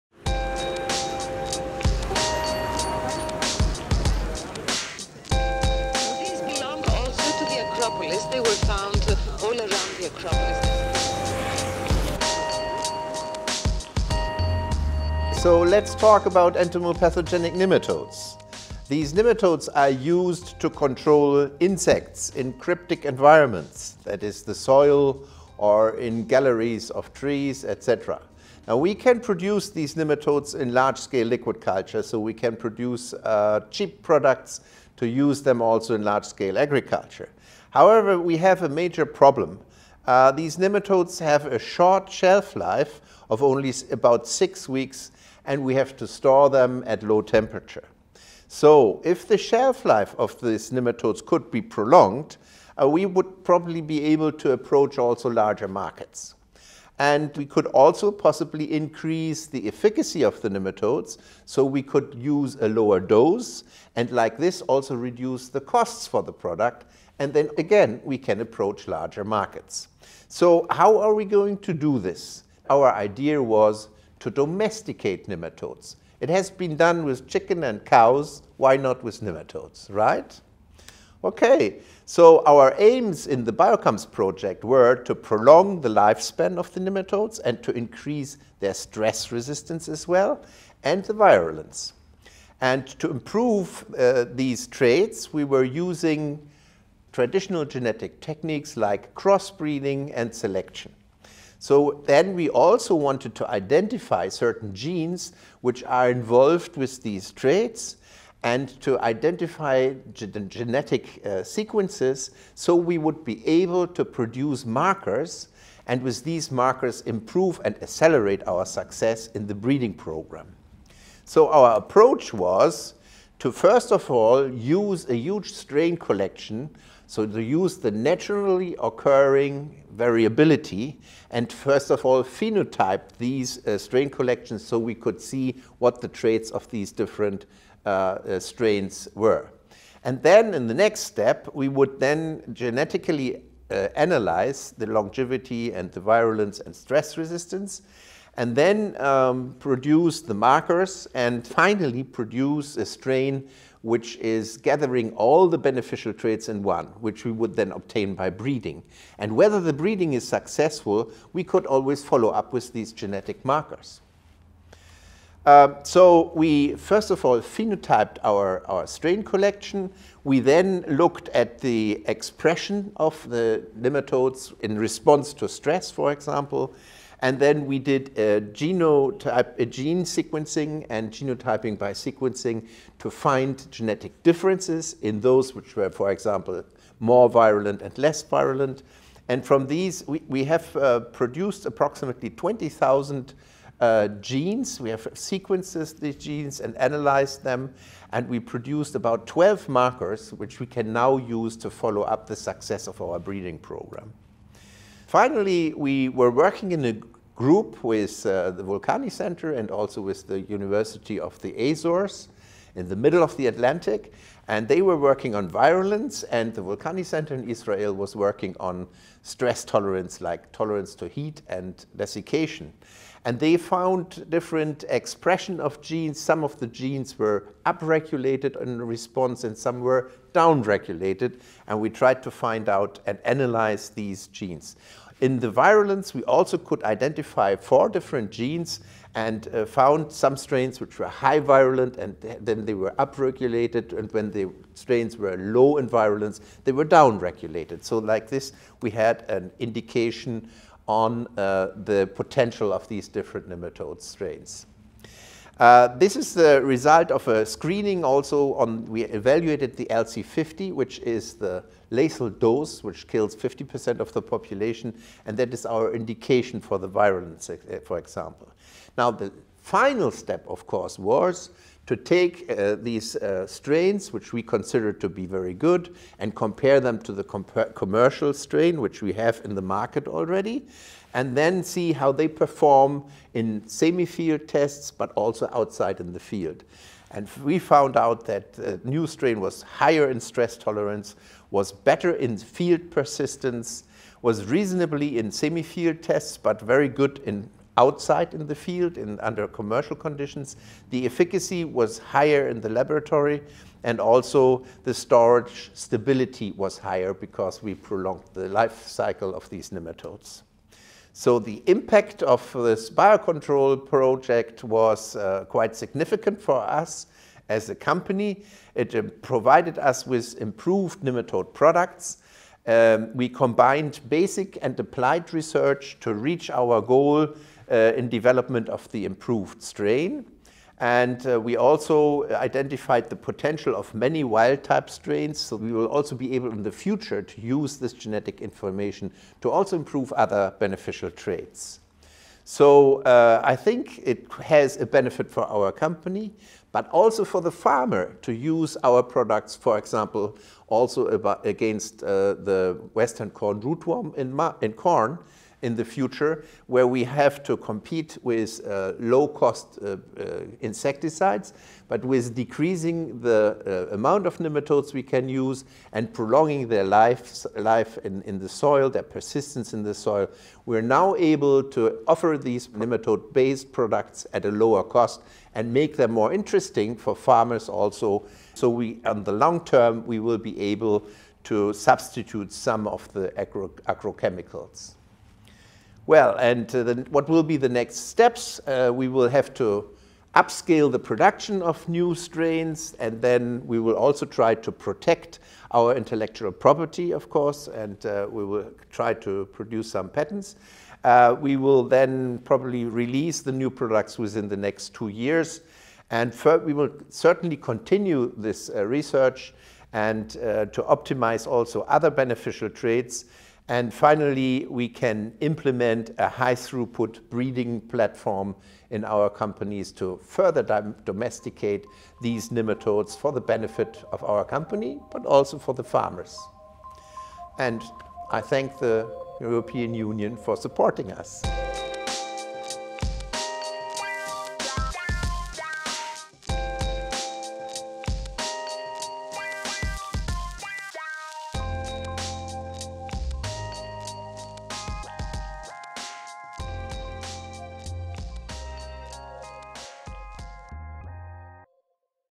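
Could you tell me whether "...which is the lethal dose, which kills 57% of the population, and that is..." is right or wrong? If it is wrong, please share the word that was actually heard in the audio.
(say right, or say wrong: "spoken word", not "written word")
wrong: "50", not "57".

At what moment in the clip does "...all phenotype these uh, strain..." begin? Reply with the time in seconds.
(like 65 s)
132 s.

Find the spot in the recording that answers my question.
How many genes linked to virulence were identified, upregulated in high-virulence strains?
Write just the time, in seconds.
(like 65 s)
237 s.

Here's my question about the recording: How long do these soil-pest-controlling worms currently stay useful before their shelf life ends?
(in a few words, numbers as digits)
about 6 weeks.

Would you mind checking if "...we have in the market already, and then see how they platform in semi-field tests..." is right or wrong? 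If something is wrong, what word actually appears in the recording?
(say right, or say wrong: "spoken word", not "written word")
wrong: "perform", not "platform".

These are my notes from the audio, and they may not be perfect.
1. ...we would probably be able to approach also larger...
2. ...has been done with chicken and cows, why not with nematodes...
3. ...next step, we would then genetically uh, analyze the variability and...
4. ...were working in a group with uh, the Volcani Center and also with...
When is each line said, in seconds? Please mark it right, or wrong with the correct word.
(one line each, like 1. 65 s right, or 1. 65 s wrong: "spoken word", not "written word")
1. 52 s right
2. 76 s right
3. 140 s wrong: "longevity", not "variability"
4. 206 s right.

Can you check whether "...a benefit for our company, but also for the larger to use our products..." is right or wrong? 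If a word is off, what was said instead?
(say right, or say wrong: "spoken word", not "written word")
wrong: "farmer", not "larger".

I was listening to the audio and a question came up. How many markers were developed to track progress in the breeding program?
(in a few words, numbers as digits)
12.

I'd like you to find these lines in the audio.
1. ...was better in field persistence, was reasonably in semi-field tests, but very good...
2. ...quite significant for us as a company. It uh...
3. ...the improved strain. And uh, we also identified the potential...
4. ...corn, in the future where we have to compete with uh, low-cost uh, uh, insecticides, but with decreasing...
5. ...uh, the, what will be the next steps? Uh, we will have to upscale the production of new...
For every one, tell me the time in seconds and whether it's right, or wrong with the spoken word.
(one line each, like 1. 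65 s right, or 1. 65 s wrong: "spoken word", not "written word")
1. 291 s right
2. 315 s right
3. 328 s right
4. 354 s right
5. 386 s right.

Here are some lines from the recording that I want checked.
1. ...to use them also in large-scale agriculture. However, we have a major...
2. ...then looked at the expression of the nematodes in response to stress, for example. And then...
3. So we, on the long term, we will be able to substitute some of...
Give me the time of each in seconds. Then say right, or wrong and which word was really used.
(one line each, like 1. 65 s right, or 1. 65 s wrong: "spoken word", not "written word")
1. 34 s right
2. 170 s right
3. 378 s right.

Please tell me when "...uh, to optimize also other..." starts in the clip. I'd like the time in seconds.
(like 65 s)
410 s.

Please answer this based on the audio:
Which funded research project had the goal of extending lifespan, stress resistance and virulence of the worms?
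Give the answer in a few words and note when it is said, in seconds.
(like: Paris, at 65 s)
BIOCOMES, at 83 s.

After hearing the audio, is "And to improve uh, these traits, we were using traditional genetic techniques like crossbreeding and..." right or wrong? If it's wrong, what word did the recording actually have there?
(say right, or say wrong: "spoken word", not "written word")
right.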